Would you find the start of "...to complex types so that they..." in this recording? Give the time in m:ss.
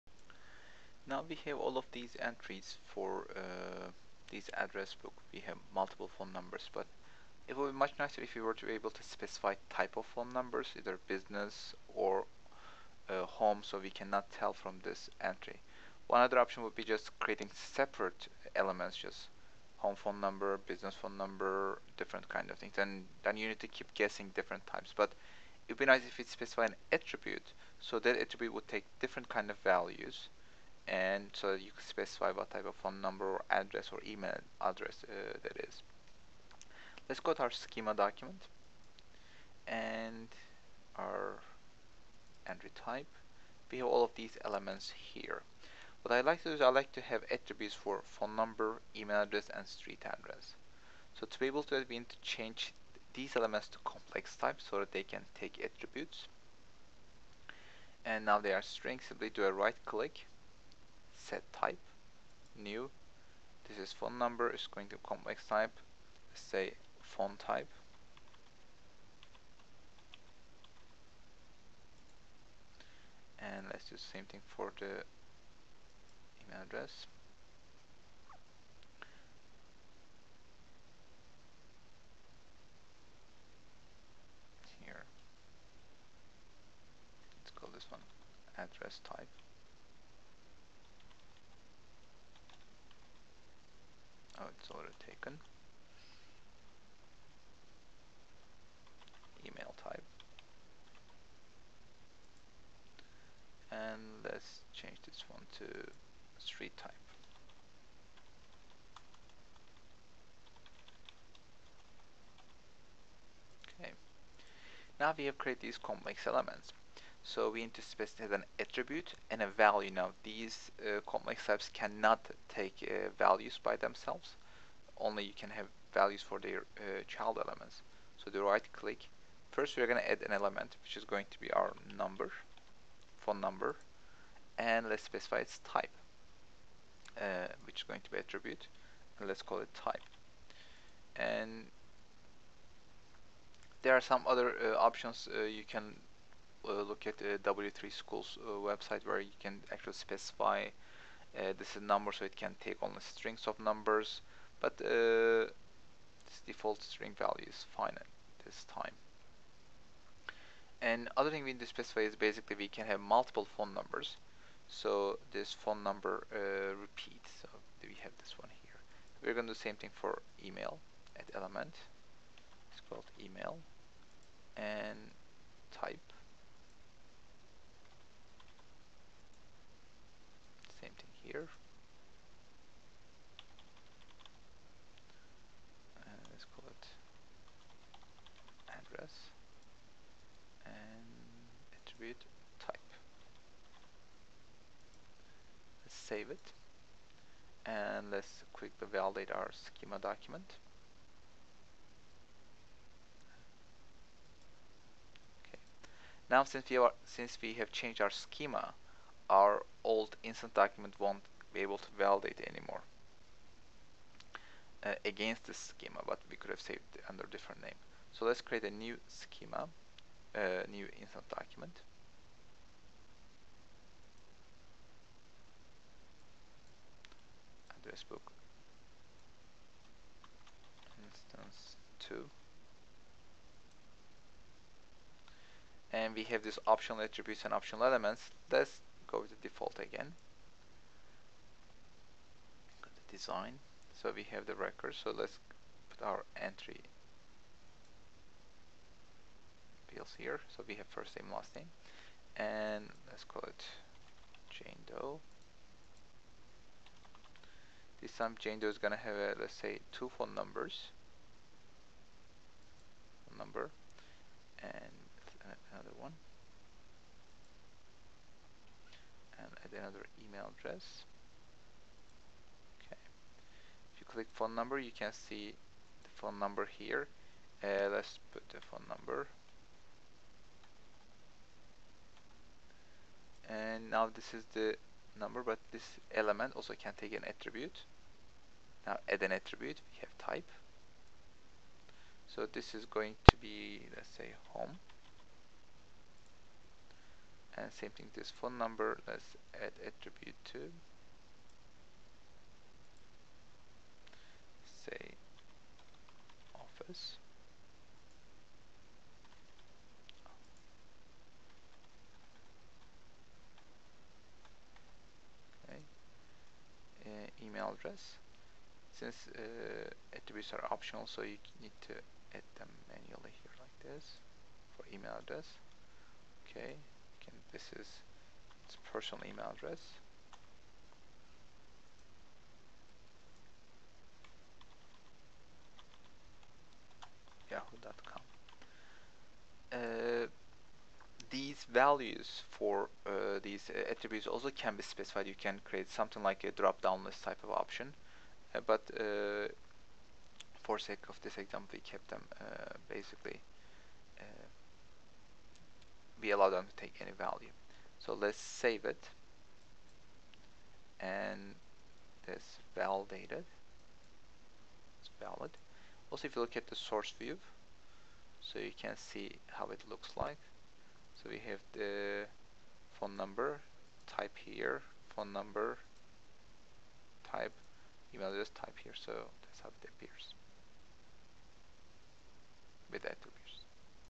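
0:53.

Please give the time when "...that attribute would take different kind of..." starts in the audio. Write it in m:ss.
0:27.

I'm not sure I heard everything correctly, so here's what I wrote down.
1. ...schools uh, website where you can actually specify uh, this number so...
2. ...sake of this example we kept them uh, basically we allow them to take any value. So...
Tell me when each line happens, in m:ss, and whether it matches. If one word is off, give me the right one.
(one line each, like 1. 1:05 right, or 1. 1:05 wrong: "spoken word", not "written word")
1. 2:27 right
2. 5:50 right.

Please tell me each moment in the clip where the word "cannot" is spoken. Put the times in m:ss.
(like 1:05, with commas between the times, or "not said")
0:13, 2:01.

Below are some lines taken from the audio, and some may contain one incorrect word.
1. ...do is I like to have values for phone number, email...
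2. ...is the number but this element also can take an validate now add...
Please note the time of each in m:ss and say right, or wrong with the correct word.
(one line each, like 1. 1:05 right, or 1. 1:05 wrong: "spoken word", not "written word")
1. 0:46 wrong: "attributes", not "values"
2. 4:44 wrong: "attribute", not "validate".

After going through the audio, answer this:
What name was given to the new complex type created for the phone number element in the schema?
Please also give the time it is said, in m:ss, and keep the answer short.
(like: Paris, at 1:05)
Font type, at 1:07.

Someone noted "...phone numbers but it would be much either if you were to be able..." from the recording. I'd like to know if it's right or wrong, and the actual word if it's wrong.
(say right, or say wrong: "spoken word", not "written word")
wrong: "nicer", not "either".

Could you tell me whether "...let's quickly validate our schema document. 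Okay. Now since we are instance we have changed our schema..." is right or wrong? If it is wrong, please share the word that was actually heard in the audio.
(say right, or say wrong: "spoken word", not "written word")
wrong: "since", not "instance".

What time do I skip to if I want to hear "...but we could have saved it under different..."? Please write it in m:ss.
3:36.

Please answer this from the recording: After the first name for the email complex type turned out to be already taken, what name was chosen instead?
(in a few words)
Email type.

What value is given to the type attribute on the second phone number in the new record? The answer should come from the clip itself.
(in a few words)
office.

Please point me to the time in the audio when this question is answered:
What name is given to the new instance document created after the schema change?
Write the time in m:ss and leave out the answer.
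3:47.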